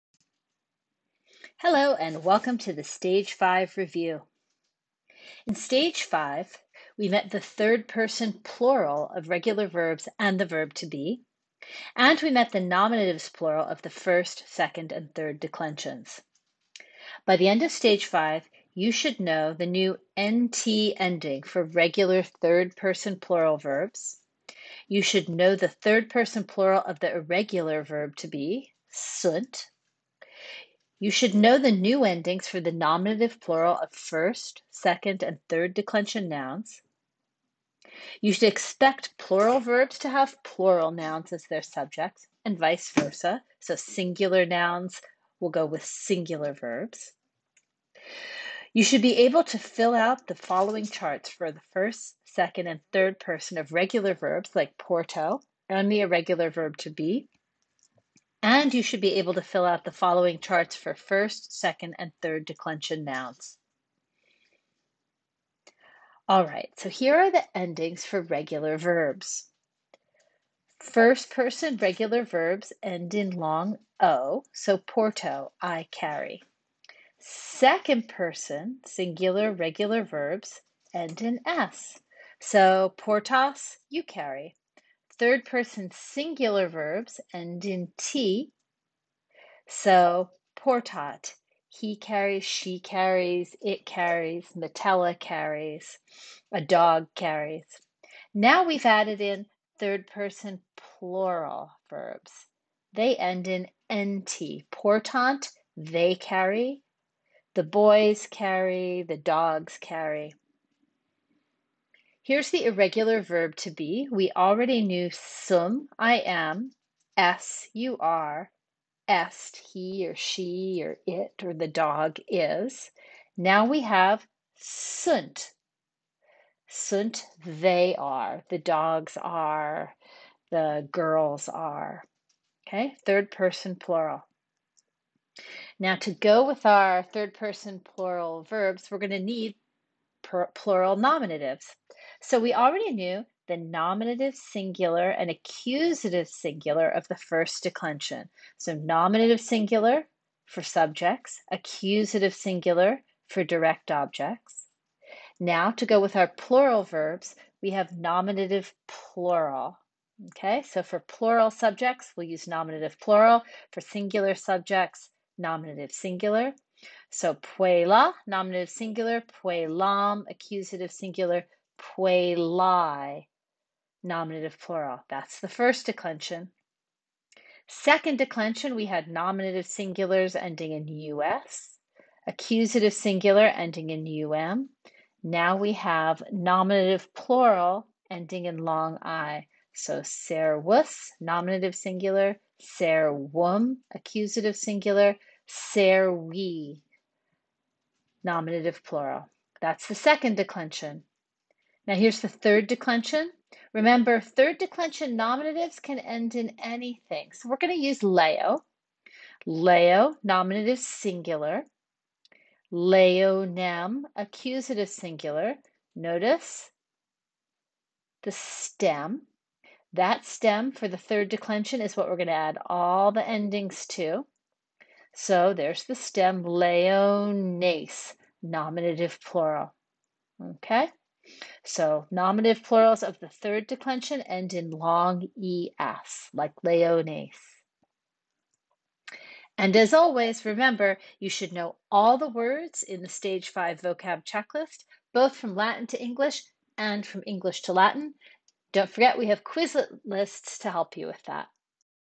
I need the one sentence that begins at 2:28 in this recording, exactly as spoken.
So nominative singular for subjects, accusative singular for direct objects.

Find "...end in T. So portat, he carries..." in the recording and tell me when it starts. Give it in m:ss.
1:27.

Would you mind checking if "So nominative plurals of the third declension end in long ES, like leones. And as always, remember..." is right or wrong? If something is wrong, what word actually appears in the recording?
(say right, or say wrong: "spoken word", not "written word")
right.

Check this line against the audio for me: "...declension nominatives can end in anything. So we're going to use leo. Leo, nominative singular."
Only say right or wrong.
right.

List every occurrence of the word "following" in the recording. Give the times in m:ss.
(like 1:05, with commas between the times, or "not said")
0:50, 0:59.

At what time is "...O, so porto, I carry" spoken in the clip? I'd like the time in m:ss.
1:13.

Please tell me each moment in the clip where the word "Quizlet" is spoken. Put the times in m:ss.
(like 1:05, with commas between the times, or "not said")
4:09.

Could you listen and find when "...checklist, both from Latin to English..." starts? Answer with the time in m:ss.
4:04.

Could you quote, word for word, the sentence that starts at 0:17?
By the end of Stage 5, you should know the new NT ending for regular third person plural verbs.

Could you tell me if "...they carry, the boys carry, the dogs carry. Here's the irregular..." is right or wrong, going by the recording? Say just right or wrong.
right.